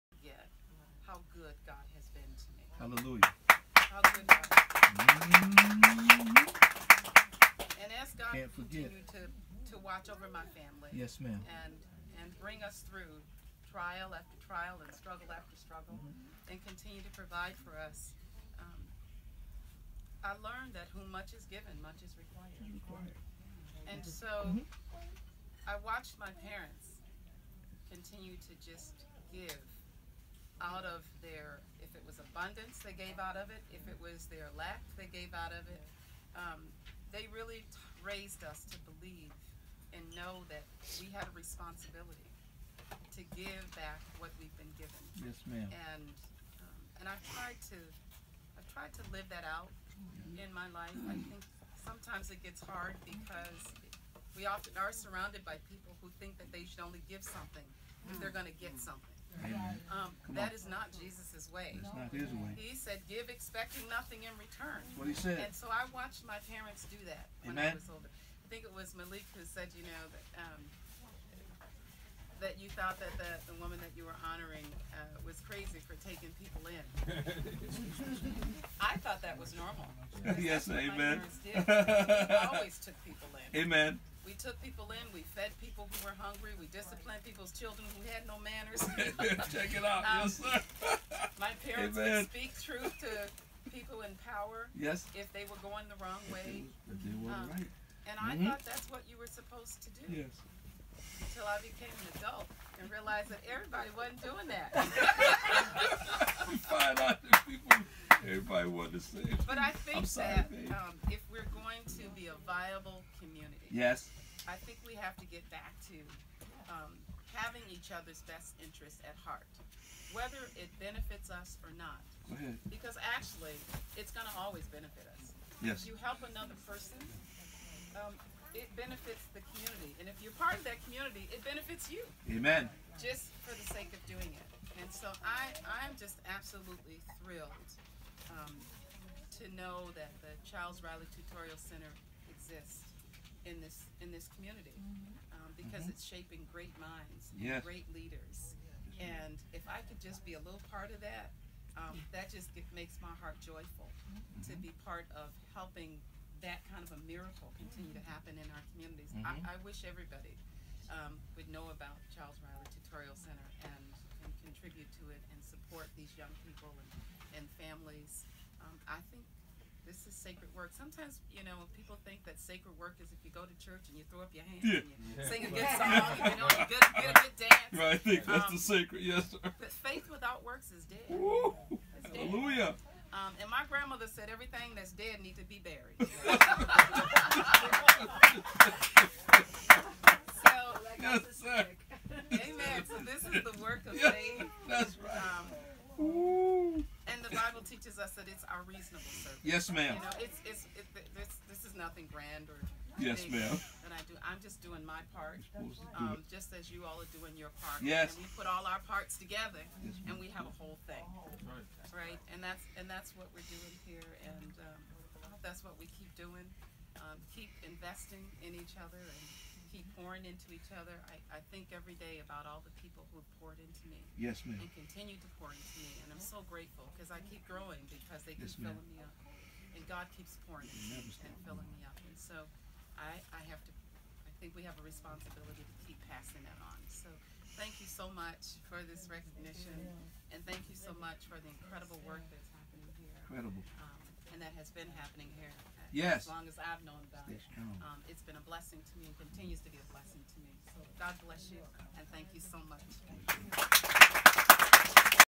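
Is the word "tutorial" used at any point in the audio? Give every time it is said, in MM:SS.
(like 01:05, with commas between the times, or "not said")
02:21, 02:42.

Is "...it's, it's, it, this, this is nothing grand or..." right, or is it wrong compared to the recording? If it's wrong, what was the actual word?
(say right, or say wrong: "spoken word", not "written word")
right.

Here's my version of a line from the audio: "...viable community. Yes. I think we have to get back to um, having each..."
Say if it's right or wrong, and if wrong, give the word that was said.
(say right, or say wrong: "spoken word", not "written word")
right.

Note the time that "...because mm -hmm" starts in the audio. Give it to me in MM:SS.
02:25.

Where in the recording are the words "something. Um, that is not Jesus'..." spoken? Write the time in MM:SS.
00:58.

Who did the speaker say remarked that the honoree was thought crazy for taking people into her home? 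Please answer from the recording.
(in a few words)
Malik.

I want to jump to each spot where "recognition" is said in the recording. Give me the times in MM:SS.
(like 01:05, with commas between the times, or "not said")
03:59.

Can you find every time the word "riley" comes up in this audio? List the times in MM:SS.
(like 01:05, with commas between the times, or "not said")
02:20, 02:42.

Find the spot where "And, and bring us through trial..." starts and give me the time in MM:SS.
00:11.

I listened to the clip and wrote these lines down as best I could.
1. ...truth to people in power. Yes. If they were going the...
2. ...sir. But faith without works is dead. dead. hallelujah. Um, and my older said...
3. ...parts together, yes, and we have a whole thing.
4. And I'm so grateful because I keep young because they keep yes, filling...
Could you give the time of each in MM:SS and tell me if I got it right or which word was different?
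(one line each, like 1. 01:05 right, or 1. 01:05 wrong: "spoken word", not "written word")
1. 01:32 right
2. 02:59 wrong: "grandmother", not "older"
3. 03:28 right
4. 03:46 wrong: "growing", not "young".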